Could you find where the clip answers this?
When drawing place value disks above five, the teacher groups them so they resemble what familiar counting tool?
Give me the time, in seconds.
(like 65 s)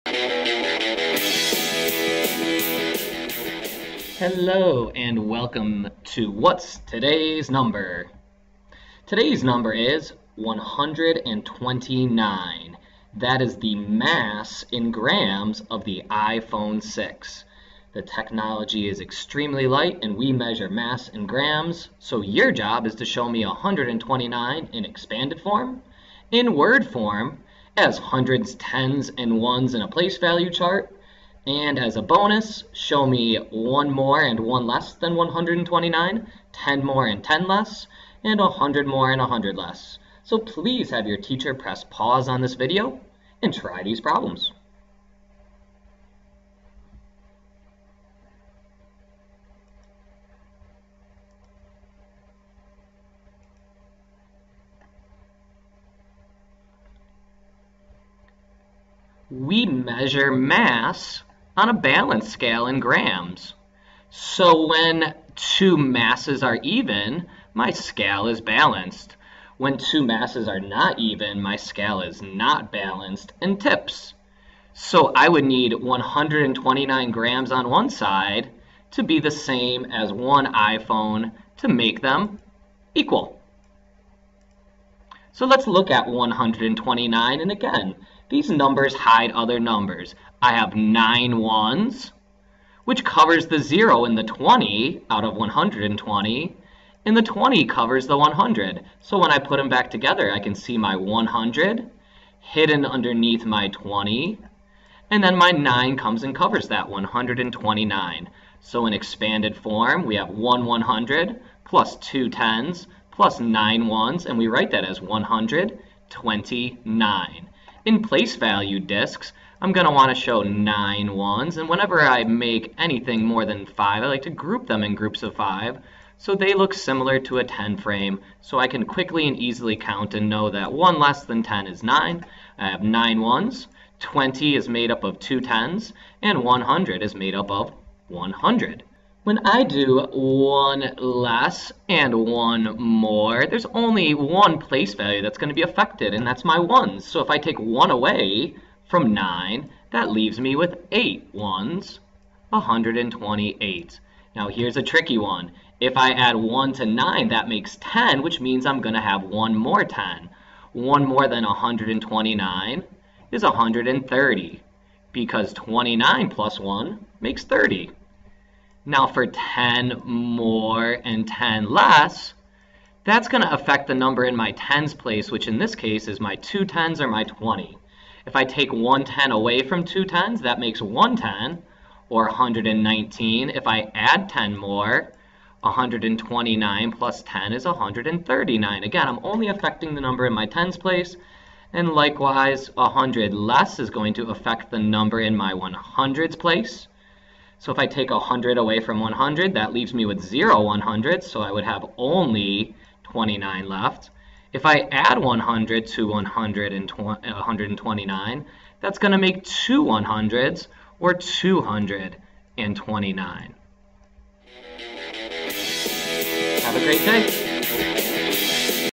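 127 s.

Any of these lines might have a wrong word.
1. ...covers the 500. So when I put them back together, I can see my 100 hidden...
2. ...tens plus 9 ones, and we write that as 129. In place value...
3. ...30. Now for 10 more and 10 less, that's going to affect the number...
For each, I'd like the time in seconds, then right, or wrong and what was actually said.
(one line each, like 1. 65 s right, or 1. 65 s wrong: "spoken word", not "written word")
1. 97 s wrong: "100", not "500"
2. 112 s right
3. 167 s right.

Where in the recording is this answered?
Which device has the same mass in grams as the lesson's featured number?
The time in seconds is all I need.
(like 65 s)
16 s.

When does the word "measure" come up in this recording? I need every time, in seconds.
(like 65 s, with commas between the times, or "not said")
20 s, 59 s.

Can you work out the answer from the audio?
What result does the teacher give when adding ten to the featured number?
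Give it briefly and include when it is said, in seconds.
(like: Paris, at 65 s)
139, at 187 s.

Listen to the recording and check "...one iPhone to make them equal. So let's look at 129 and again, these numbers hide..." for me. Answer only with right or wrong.
right.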